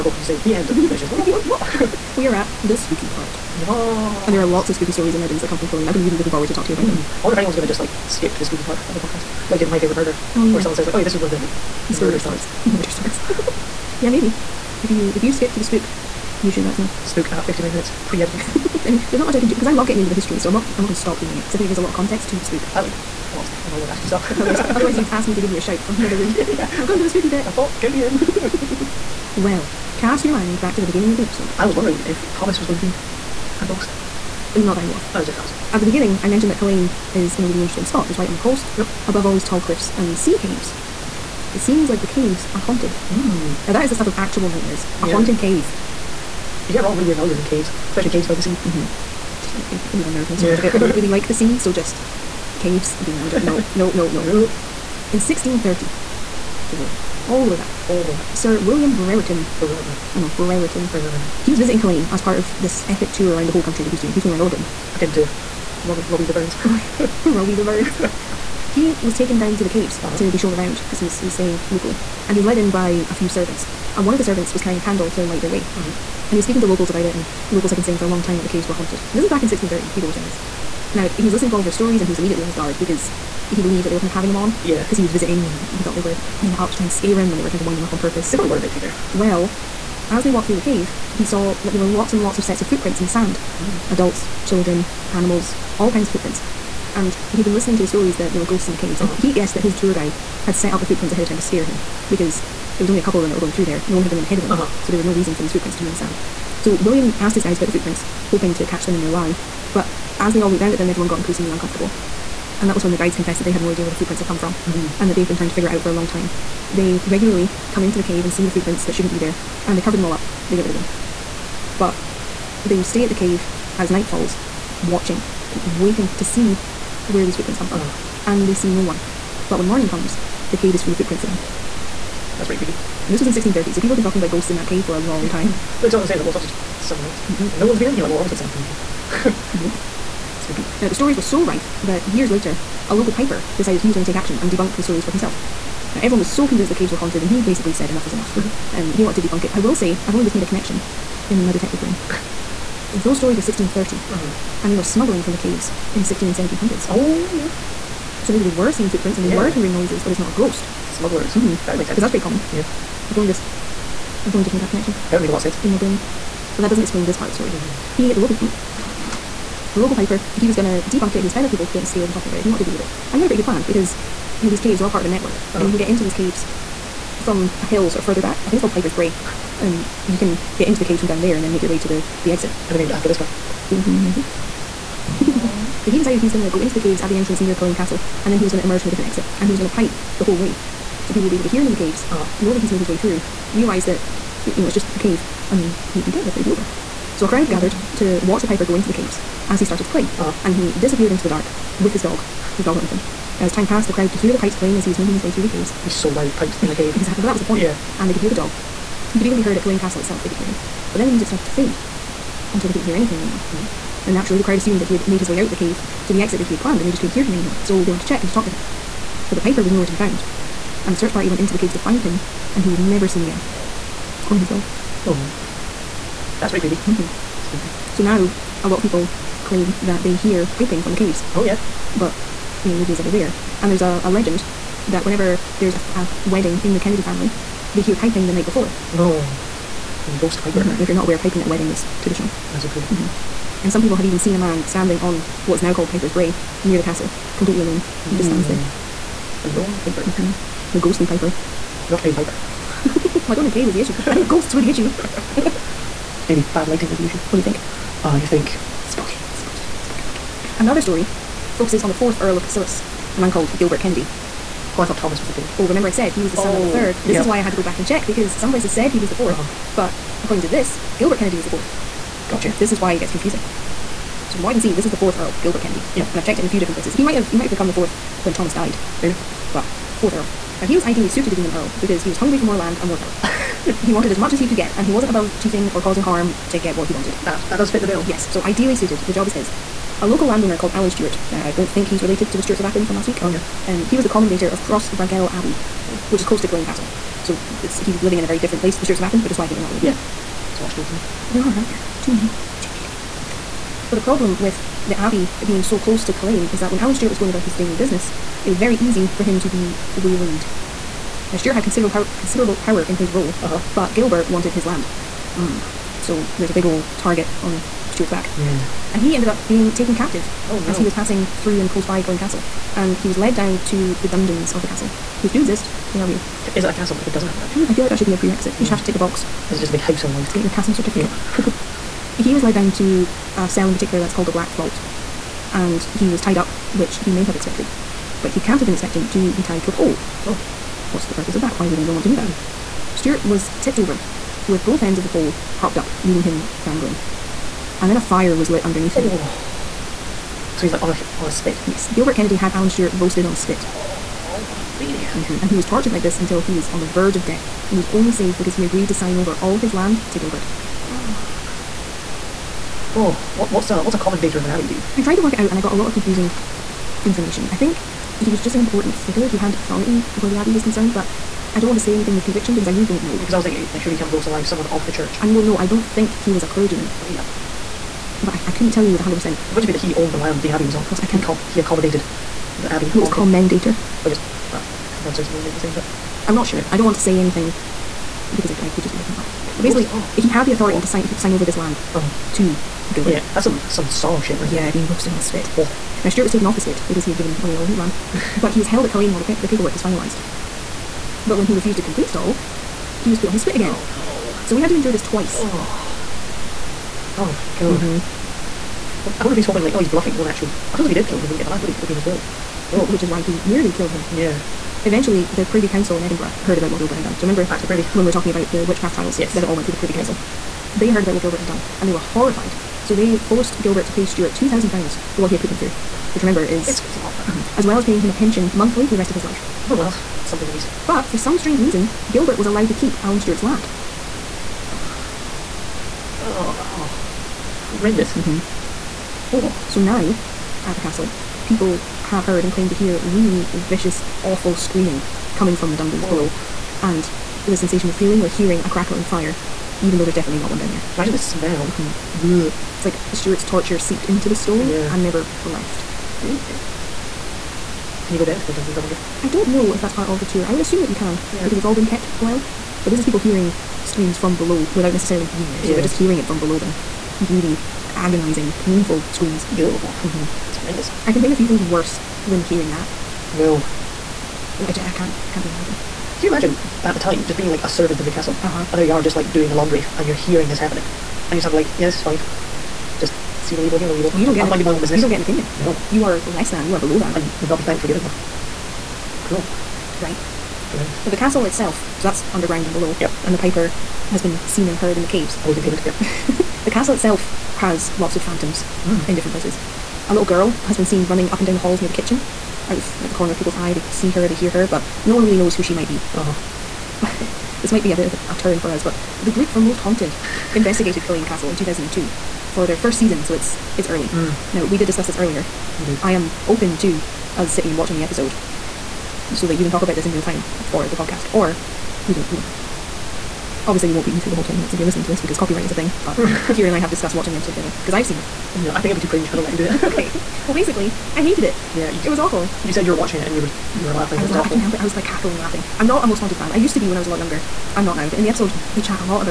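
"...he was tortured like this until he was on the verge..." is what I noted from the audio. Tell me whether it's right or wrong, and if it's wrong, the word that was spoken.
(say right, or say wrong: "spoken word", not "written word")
right.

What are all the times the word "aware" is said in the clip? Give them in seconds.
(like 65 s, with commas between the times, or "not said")
241 s.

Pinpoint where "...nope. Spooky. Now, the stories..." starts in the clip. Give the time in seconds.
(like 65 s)
139 s.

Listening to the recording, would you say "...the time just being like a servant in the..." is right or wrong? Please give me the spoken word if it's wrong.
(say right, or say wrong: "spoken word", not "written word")
right.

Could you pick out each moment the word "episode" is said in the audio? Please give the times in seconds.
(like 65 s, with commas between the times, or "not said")
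31 s, 518 s, 527 s, 538 s.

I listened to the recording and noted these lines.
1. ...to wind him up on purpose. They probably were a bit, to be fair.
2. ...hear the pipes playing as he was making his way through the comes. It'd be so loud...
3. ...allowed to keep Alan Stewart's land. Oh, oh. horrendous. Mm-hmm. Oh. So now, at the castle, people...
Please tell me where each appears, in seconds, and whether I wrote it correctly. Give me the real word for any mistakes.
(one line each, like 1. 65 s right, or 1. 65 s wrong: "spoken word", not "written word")
1. 87 s right
2. 204 s wrong: "caves", not "comes"
3. 432 s right.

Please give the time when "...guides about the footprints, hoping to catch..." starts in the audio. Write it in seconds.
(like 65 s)
107 s.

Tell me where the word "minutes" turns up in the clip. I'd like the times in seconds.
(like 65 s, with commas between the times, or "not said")
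17 s, 524 s.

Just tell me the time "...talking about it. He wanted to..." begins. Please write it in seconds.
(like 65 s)
172 s.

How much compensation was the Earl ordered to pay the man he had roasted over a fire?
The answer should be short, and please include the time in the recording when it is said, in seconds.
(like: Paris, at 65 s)
2000 pounds, at 424 s.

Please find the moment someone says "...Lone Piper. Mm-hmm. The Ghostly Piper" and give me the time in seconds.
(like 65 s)
249 s.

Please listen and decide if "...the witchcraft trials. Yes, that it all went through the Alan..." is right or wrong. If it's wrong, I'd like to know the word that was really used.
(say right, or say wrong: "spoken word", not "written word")
wrong: "Privy", not "Alan".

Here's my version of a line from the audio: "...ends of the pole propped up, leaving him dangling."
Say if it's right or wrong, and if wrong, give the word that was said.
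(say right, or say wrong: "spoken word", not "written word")
right.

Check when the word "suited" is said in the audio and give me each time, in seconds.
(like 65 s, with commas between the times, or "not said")
281 s, 288 s.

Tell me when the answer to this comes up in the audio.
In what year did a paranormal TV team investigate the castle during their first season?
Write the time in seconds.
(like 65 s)
511 s.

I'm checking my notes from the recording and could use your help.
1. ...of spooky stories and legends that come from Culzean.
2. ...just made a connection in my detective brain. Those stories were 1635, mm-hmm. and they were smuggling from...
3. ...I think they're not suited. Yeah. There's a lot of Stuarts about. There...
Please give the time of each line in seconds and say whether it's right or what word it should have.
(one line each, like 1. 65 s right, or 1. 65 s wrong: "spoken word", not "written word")
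1. 4 s right
2. 150 s wrong: "1630", not "1635"
3. 299 s wrong: "related", not "suited".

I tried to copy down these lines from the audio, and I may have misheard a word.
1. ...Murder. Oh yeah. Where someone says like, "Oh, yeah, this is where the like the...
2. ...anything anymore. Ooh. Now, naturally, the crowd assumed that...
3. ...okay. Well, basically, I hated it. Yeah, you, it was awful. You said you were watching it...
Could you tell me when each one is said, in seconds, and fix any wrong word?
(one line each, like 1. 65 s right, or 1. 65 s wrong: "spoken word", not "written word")
1. 9 s right
2. 212 s right
3. 529 s right.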